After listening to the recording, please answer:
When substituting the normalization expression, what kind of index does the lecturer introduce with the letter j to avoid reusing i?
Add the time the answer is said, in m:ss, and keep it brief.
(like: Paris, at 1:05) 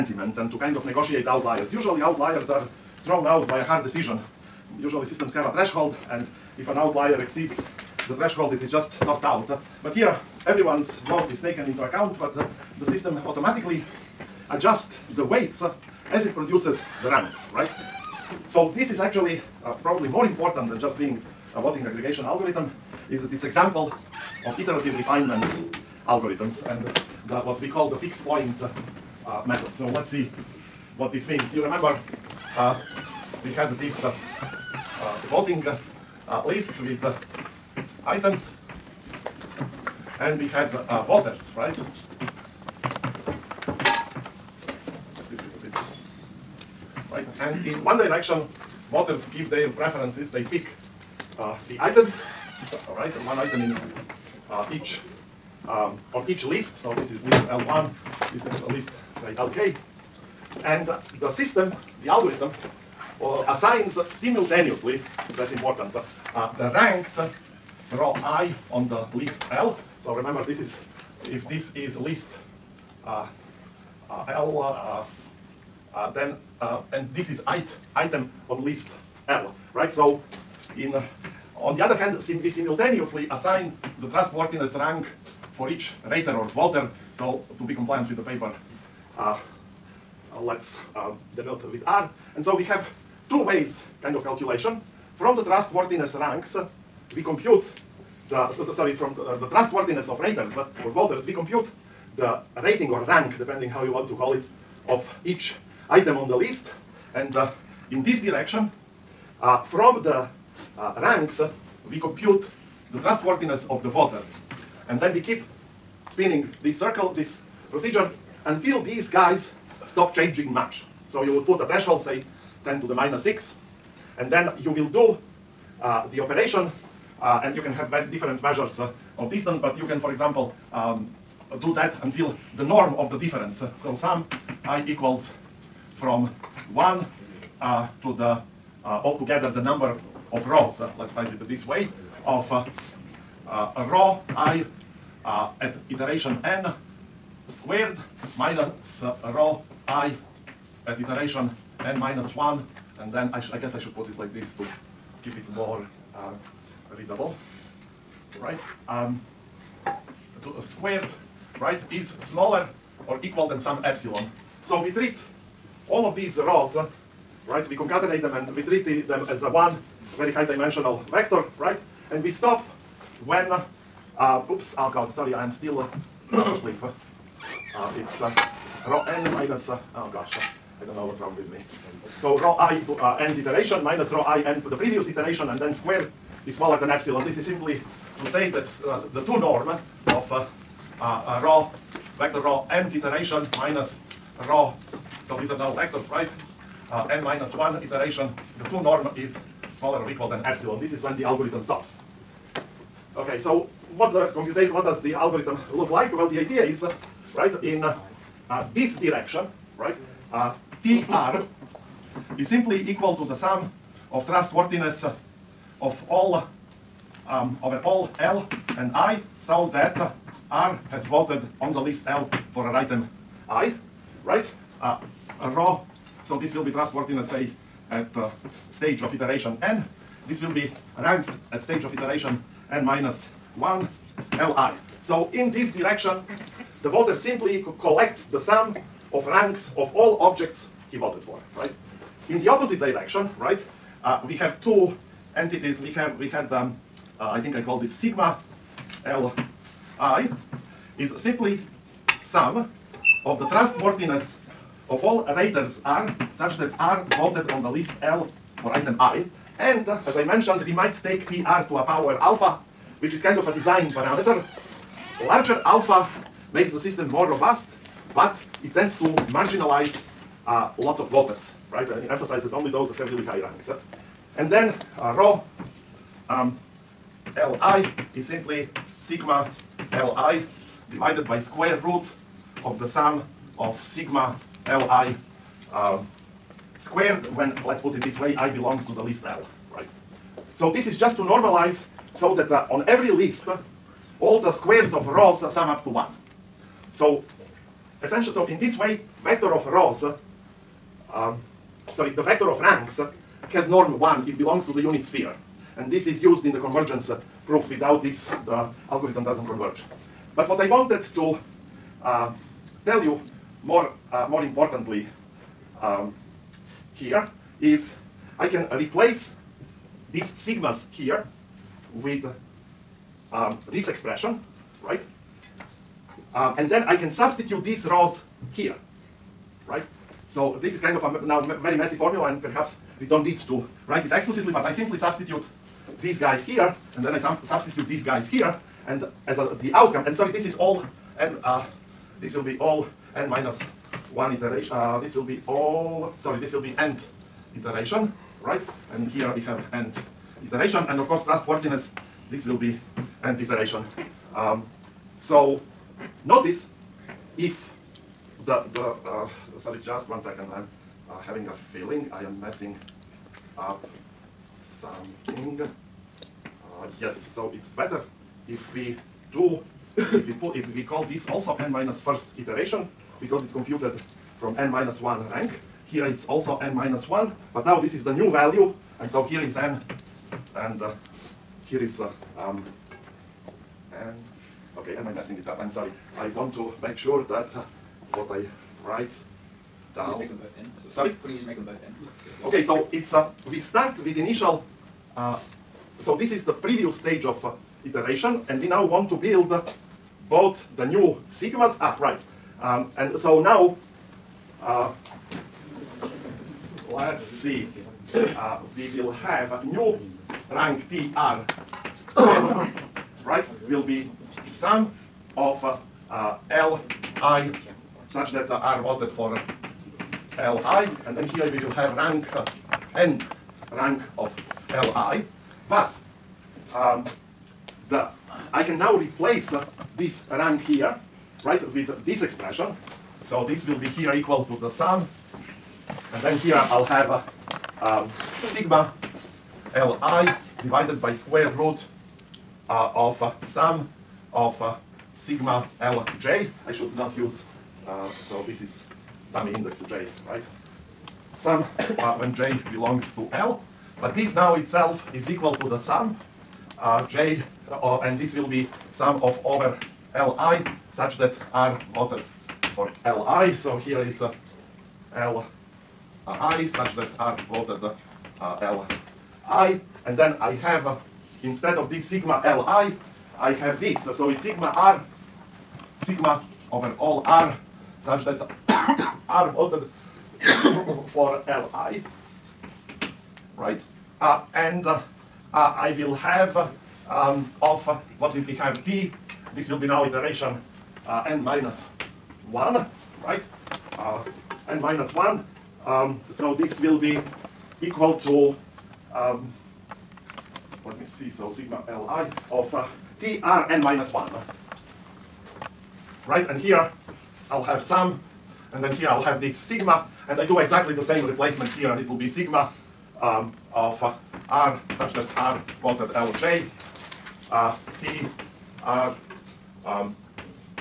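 dummy index, at 7:29.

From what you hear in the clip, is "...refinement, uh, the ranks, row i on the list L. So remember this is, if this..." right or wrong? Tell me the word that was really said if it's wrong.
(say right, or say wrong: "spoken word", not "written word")
wrong: "important", not "refinement".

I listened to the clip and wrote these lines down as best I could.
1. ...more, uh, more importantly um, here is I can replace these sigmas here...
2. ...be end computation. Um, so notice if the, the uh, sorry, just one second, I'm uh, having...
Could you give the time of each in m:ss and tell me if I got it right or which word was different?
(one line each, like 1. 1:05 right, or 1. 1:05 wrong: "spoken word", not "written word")
1. 5:13 right
2. 5:52 wrong: "iteration", not "computation".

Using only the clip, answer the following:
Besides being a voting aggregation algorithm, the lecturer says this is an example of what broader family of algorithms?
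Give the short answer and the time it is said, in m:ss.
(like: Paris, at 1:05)
iterative refinement algorithms, at 0:24.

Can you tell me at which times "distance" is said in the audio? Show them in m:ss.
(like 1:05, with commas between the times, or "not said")
2:09.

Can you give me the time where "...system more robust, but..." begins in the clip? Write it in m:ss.
4:26.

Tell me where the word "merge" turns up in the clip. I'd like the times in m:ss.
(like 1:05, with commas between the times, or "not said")
not said.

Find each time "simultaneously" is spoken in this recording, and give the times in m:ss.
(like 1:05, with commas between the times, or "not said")
1:04, 1:22.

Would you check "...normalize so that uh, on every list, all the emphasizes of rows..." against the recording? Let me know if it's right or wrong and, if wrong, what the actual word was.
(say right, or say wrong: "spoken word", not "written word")
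wrong: "squares", not "emphasizes".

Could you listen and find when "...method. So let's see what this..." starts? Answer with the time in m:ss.
0:29.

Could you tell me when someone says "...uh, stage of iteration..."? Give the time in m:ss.
3:48.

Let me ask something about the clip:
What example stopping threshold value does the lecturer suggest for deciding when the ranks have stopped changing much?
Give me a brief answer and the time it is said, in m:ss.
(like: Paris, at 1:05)
10^-6, at 2:02.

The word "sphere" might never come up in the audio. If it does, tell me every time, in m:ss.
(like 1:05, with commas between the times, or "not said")
5:05.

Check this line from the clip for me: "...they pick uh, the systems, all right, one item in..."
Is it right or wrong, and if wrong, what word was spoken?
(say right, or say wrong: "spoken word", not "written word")
wrong: "items", not "systems".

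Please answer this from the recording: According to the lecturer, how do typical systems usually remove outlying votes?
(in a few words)
hard decision.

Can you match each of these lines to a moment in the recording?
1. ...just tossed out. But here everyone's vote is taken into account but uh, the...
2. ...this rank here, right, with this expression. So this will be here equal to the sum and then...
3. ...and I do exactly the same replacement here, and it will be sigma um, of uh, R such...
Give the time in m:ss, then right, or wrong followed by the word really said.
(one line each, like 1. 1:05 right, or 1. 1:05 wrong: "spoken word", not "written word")
1. 0:08 right
2. 7:09 right
3. 8:30 right.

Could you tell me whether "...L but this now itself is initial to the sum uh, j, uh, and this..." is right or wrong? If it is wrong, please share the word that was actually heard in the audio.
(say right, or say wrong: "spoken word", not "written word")
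wrong: "equal", not "initial".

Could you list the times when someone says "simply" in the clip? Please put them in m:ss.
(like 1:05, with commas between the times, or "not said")
3:07, 3:32, 3:57, 4:11, 4:38, 5:34.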